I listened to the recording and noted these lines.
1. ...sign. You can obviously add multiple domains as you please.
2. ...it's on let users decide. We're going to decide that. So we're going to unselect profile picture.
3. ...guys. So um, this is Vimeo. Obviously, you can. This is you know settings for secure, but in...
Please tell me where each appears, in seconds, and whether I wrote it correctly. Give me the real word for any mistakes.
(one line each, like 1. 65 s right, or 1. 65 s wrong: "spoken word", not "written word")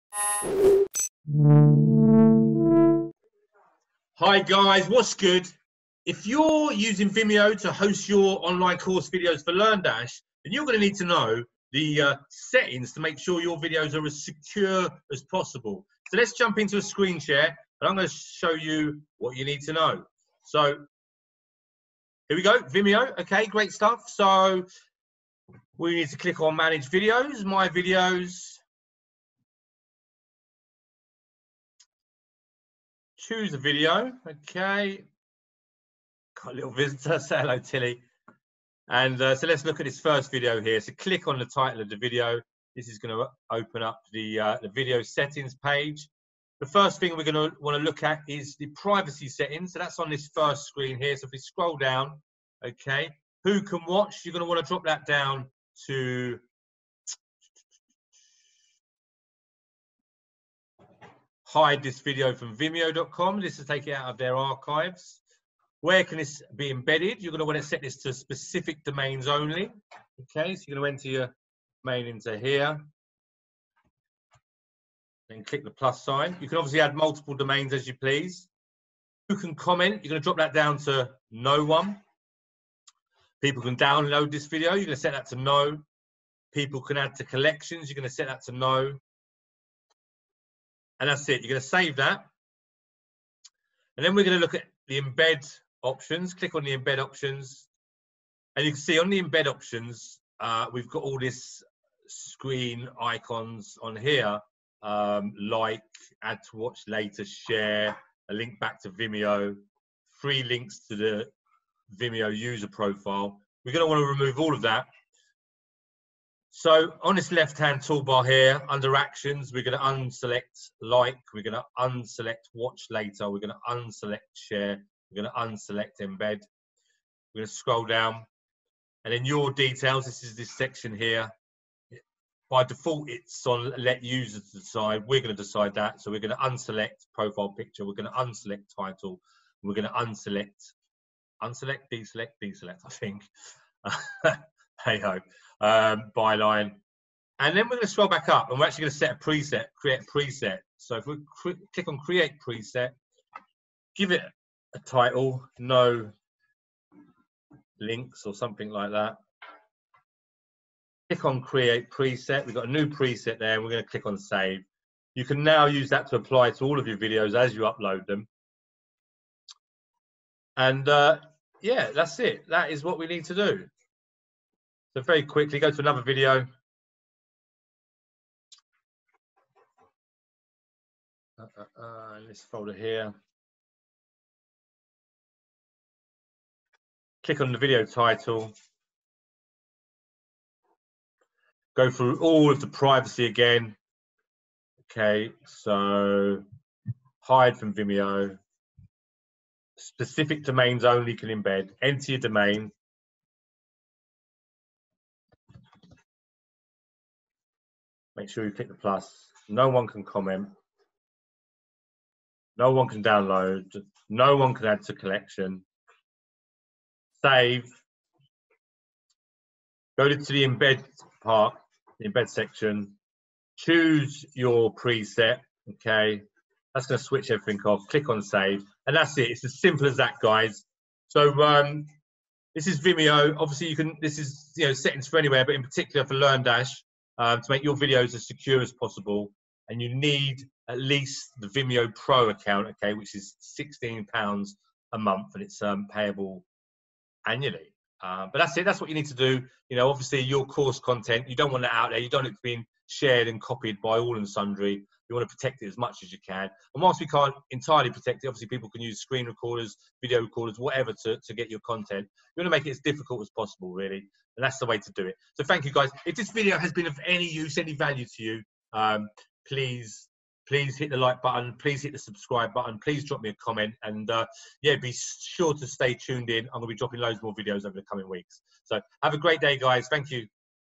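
1. 76 s right
2. 133 s right
3. 230 s wrong: "anywhere", not "secure".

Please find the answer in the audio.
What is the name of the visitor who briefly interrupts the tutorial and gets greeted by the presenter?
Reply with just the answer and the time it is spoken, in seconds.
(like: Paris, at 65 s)
Tilly, at 37 s.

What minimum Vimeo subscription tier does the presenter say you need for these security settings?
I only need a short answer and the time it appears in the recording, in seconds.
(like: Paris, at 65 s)
Vimeo Pro, at 241 s.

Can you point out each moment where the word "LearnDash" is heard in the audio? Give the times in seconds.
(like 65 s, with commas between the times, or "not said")
9 s, 236 s.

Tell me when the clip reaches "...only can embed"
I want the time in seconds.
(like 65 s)
200 s.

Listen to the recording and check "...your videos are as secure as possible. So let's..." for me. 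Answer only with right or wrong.
right.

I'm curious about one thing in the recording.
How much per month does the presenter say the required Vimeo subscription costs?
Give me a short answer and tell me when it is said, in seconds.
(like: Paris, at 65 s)
£16, at 243 s.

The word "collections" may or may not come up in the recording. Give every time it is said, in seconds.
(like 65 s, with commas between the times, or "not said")
87 s, 214 s.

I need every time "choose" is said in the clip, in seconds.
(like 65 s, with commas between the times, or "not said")
33 s, 223 s.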